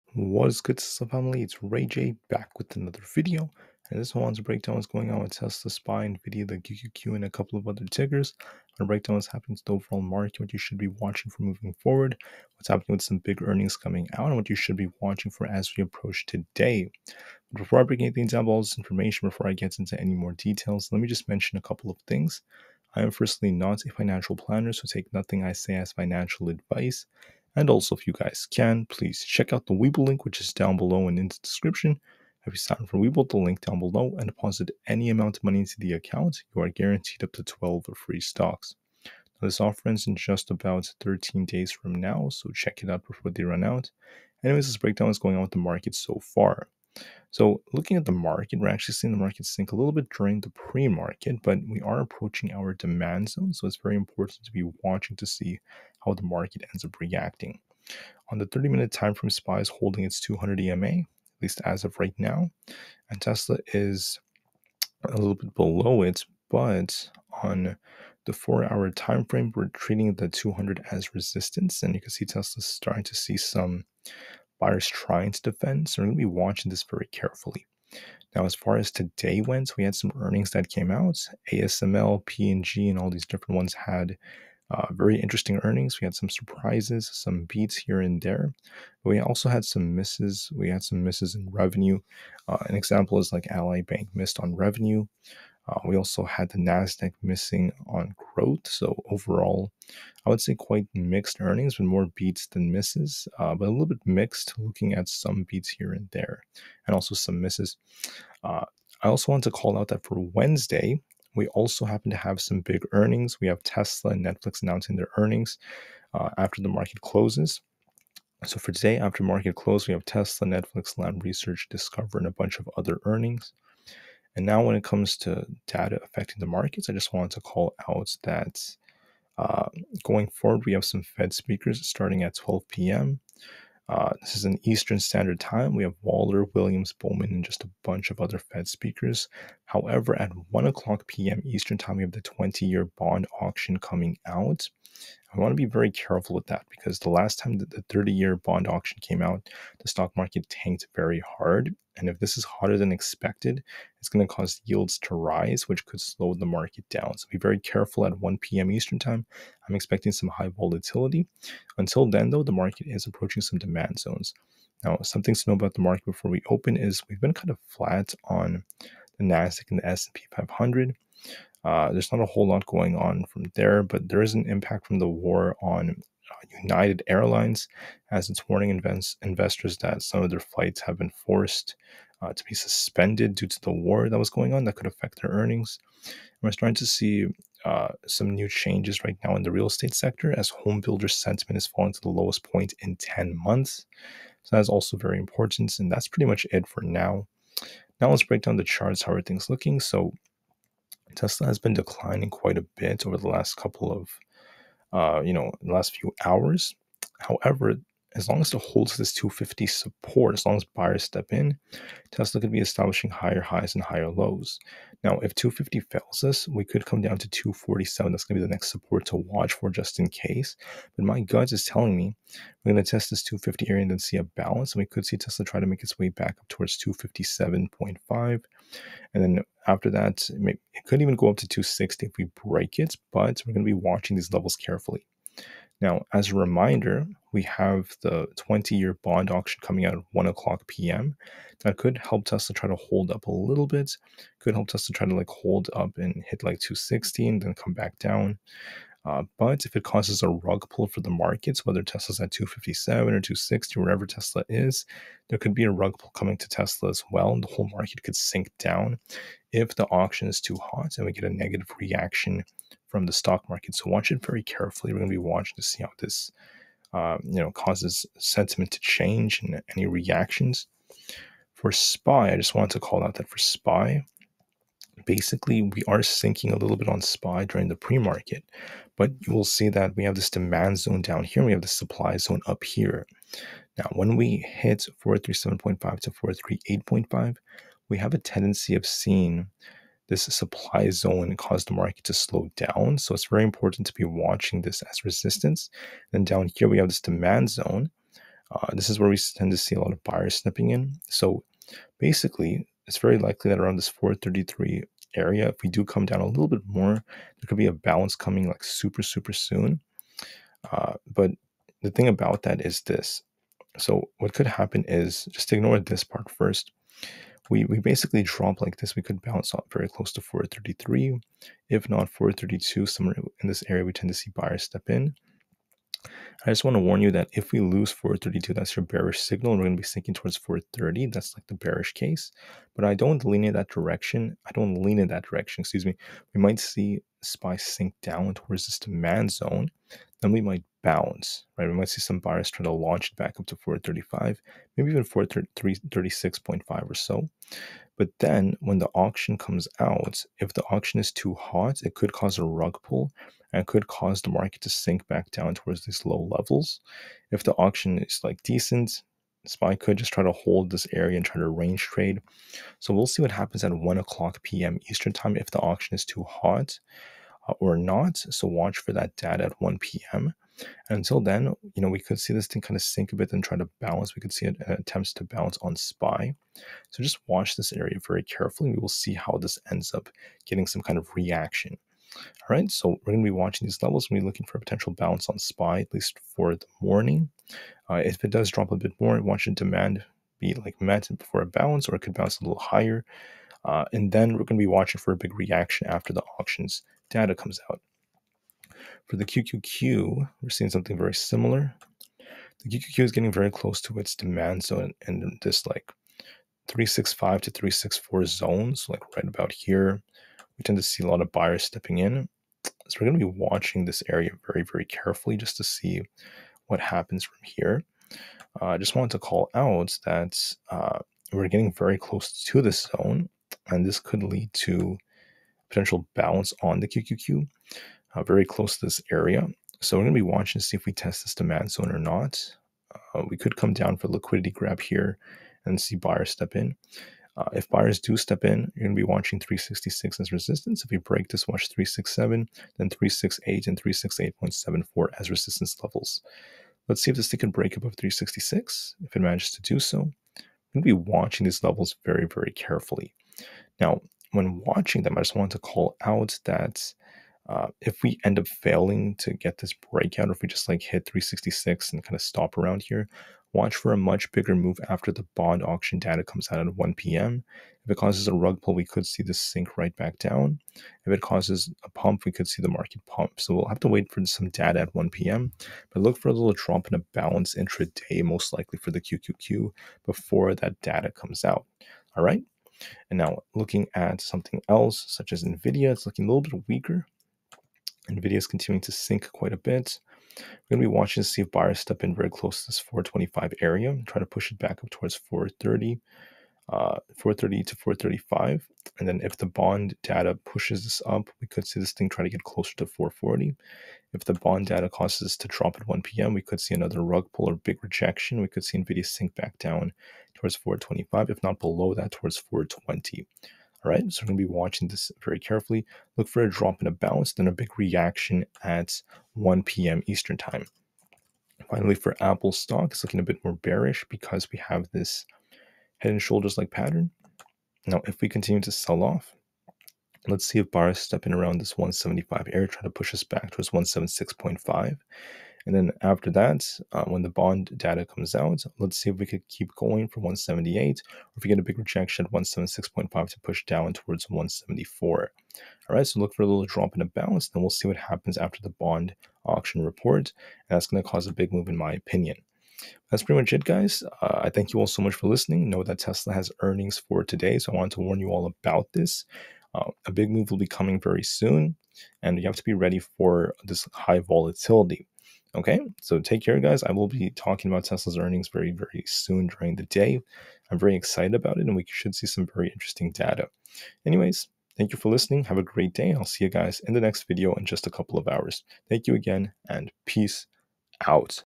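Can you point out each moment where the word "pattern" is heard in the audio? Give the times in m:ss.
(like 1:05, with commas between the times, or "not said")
8:46.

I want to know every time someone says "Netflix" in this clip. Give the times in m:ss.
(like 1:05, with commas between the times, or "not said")
1:54, 2:00.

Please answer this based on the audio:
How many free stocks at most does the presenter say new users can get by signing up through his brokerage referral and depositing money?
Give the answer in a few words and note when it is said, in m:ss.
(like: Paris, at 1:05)
12, at 0:37.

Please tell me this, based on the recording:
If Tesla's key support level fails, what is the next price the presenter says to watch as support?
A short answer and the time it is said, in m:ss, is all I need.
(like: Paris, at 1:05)
247, at 3:37.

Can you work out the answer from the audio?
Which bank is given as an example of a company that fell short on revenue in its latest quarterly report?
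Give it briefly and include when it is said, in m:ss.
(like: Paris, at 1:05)
Ally Bank, at 1:33.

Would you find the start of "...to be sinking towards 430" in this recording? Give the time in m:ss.
5:29.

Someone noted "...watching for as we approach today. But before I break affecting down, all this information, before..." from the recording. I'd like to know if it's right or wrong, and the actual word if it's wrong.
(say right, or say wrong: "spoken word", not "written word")
wrong: "anything", not "affecting".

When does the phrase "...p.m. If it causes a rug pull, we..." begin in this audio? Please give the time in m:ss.
7:46.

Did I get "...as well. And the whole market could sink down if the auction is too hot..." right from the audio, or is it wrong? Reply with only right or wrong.
right.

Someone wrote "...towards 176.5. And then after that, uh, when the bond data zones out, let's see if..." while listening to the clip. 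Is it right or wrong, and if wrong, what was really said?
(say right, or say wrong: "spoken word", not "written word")
wrong: "comes", not "zones".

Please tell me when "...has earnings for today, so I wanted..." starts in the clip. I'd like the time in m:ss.
9:16.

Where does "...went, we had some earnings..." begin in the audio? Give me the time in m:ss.
1:19.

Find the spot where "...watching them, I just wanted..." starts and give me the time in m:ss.
7:34.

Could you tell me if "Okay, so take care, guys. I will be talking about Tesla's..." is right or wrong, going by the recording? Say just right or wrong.
right.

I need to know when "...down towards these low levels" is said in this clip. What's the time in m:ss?
5:55.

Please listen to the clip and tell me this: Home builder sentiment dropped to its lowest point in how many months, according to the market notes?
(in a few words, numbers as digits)
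10 months.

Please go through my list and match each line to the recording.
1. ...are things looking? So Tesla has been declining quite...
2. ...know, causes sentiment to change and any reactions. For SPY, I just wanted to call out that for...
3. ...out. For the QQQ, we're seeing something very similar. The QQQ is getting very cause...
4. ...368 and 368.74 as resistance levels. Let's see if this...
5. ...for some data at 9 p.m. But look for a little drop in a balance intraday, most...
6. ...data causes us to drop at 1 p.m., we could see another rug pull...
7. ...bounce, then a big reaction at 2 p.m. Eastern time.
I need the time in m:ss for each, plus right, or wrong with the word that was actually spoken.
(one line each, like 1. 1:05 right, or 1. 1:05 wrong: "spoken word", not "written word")
1. 3:19 right
2. 4:27 right
3. 6:37 wrong: "close", not "cause"
4. 7:22 right
5. 7:54 wrong: "1", not "9"
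6. 8:24 right
7. 8:36 wrong: "1", not "2".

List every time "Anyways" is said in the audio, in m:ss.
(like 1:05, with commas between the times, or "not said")
0:44, 9:34.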